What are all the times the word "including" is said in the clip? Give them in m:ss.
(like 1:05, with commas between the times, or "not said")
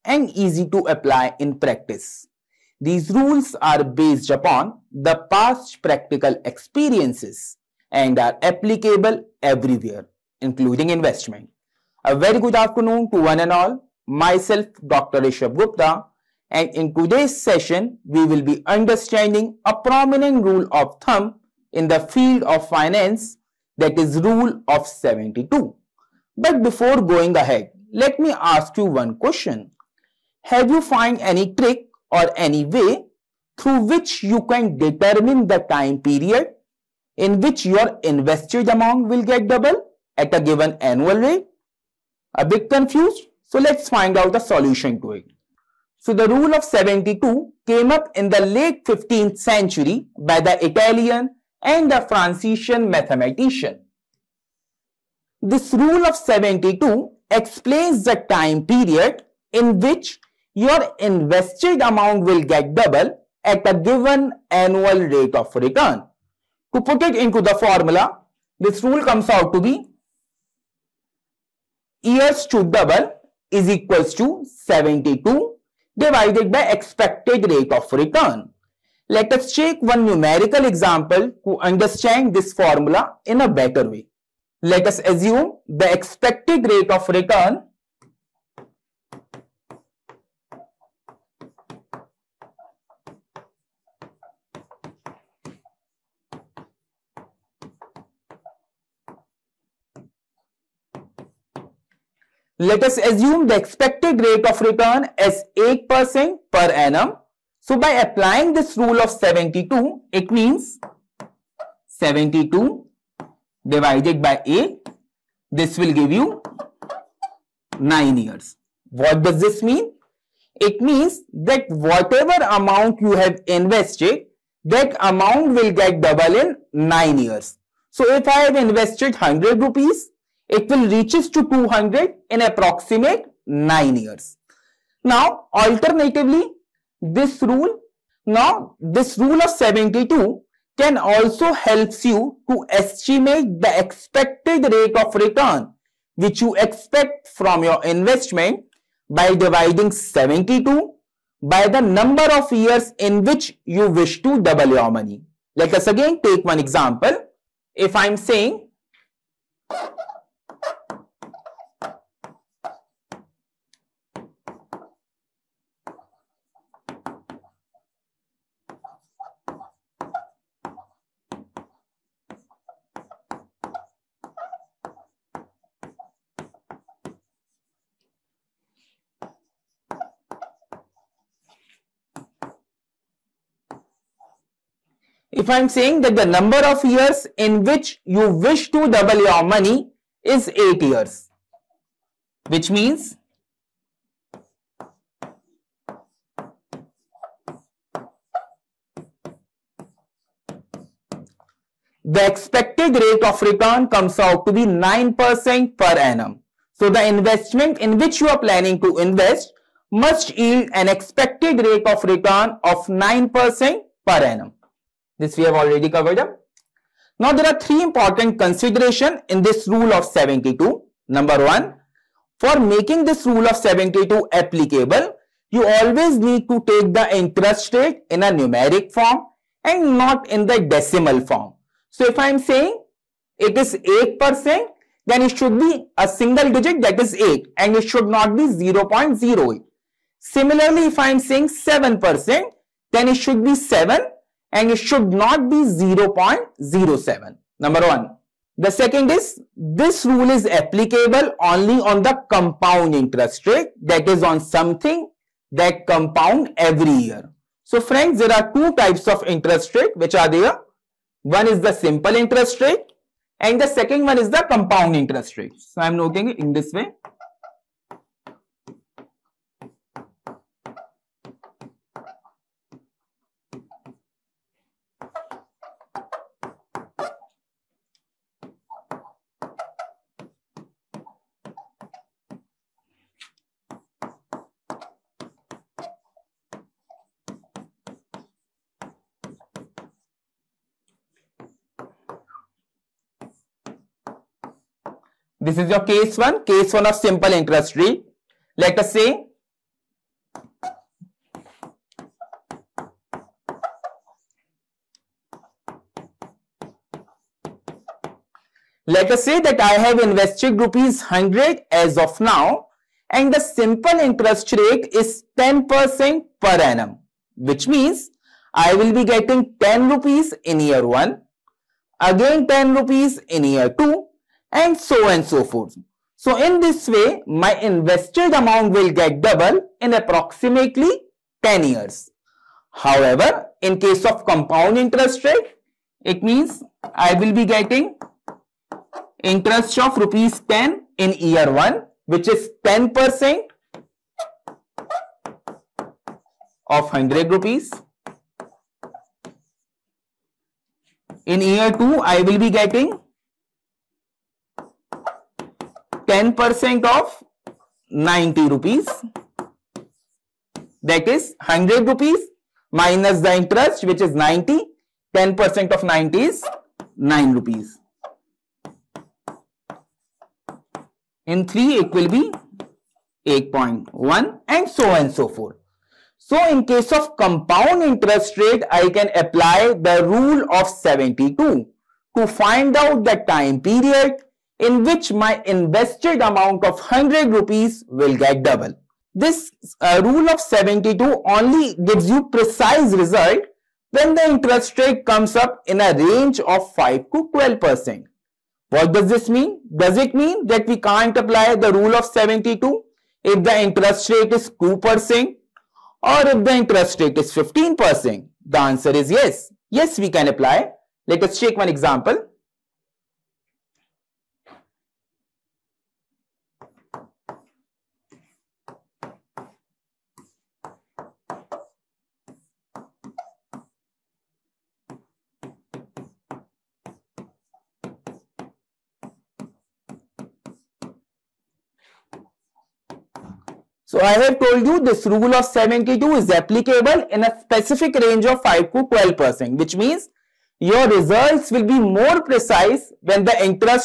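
0:10.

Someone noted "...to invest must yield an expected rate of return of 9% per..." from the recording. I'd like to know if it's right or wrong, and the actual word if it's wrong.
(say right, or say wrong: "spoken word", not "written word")
right.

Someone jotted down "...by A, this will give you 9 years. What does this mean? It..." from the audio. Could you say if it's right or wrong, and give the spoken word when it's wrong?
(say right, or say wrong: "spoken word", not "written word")
right.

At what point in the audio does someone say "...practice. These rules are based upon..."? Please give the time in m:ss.
0:01.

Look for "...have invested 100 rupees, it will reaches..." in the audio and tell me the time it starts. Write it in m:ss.
2:08.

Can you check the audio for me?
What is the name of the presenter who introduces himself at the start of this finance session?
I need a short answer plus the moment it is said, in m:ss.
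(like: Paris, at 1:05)
Dr. Rishabh Gupta, at 0:14.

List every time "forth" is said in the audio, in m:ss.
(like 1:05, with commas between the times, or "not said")
5:25, 6:15.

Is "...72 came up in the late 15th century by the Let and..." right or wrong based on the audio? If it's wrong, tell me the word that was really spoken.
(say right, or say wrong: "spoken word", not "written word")
wrong: "Italian", not "Let".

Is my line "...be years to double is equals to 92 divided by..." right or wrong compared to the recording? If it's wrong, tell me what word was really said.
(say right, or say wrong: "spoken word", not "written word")
wrong: "72", not "92".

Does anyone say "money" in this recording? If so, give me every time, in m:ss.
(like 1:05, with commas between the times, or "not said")
2:34, 3:09.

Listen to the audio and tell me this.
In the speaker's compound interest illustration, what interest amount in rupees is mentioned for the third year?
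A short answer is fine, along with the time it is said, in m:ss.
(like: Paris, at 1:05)
8.1, at 6:13.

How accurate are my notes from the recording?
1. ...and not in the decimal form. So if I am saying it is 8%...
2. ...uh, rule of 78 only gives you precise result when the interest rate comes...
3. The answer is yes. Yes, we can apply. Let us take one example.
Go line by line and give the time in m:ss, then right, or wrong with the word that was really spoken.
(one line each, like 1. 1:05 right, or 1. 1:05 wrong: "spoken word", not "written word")
1. 3:49 right
2. 6:29 wrong: "72", not "78"
3. 6:48 right.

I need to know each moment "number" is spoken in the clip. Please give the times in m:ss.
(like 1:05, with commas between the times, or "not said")
2:31, 3:06, 3:41, 4:07.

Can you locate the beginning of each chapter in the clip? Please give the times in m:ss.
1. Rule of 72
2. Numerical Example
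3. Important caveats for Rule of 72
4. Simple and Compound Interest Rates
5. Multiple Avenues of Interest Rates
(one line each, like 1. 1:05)
1. 0:44
2. 1:22
3. 3:36
4. 4:19
5. 6:56.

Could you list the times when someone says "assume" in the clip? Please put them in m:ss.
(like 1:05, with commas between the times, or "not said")
1:24, 1:42.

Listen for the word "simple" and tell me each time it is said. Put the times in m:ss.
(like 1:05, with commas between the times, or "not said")
4:21, 4:56, 5:13.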